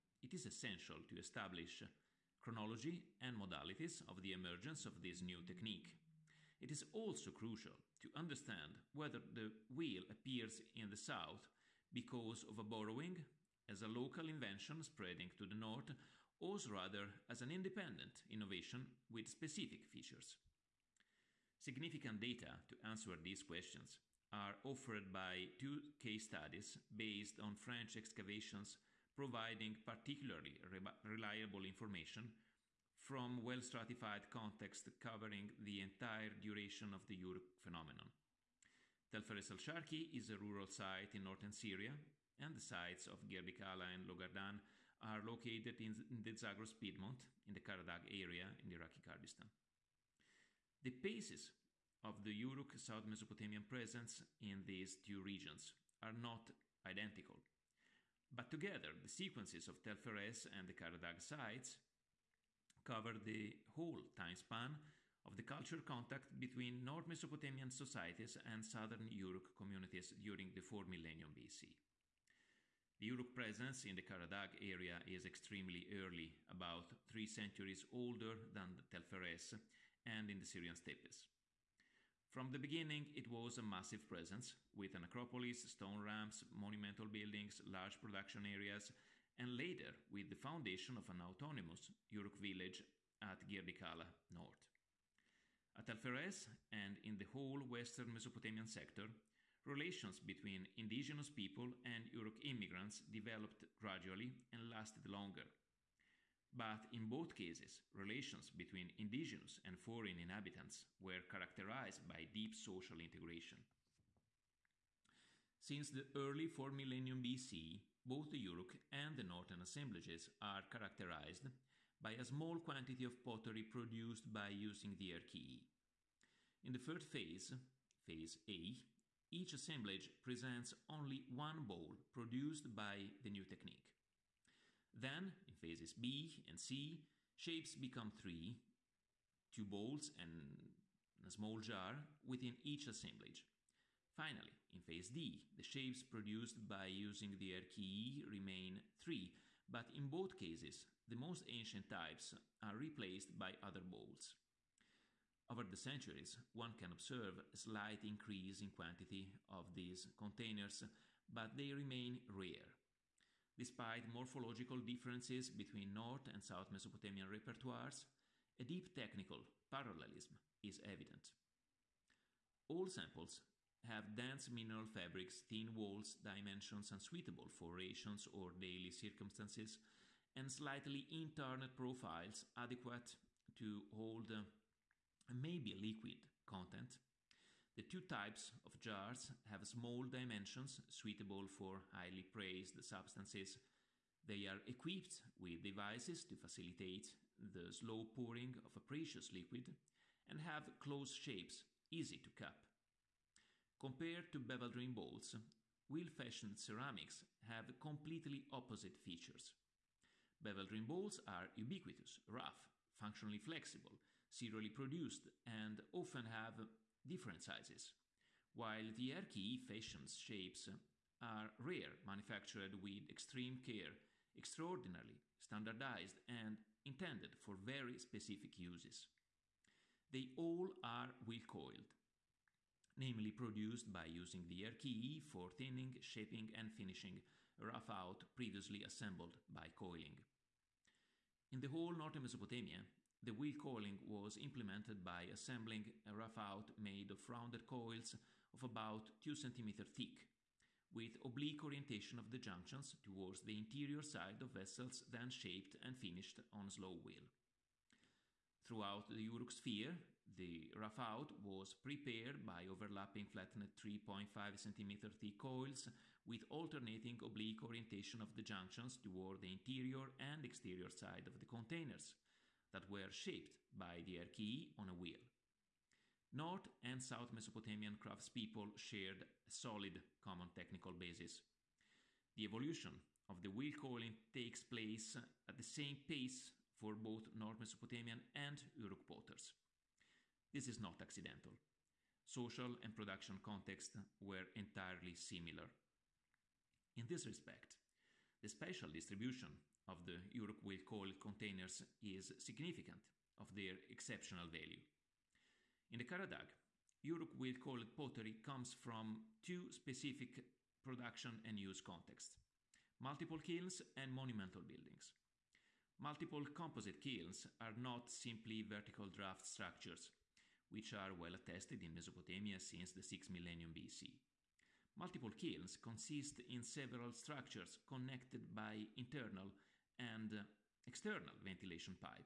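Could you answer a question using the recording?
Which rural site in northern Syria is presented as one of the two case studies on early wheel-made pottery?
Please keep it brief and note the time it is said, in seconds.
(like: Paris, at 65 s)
Tel Feres al Sharki, at 39 s.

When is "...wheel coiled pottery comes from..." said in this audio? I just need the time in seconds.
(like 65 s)
307 s.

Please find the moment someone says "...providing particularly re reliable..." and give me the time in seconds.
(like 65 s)
29 s.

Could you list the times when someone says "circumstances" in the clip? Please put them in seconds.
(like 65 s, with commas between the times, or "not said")
178 s.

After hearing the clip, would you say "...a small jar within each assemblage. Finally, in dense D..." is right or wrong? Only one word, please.
wrong.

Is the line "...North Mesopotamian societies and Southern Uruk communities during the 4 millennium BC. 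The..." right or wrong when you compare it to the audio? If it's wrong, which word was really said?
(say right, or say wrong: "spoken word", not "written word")
right.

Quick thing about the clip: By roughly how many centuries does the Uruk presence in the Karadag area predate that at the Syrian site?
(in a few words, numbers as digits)
3.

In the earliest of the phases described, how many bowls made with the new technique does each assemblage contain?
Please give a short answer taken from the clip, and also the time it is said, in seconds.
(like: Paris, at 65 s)
1, at 130 s.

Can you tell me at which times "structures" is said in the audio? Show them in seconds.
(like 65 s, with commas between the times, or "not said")
319 s, 327 s.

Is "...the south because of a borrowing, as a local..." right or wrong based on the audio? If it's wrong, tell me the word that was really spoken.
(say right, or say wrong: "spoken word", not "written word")
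right.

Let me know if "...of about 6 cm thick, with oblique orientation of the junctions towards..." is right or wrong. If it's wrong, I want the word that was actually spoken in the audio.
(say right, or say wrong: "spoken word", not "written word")
wrong: "2", not "6".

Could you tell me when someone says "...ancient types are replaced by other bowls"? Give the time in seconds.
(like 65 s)
151 s.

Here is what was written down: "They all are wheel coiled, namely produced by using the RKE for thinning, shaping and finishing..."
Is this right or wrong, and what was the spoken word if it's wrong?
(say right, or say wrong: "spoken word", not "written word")
right.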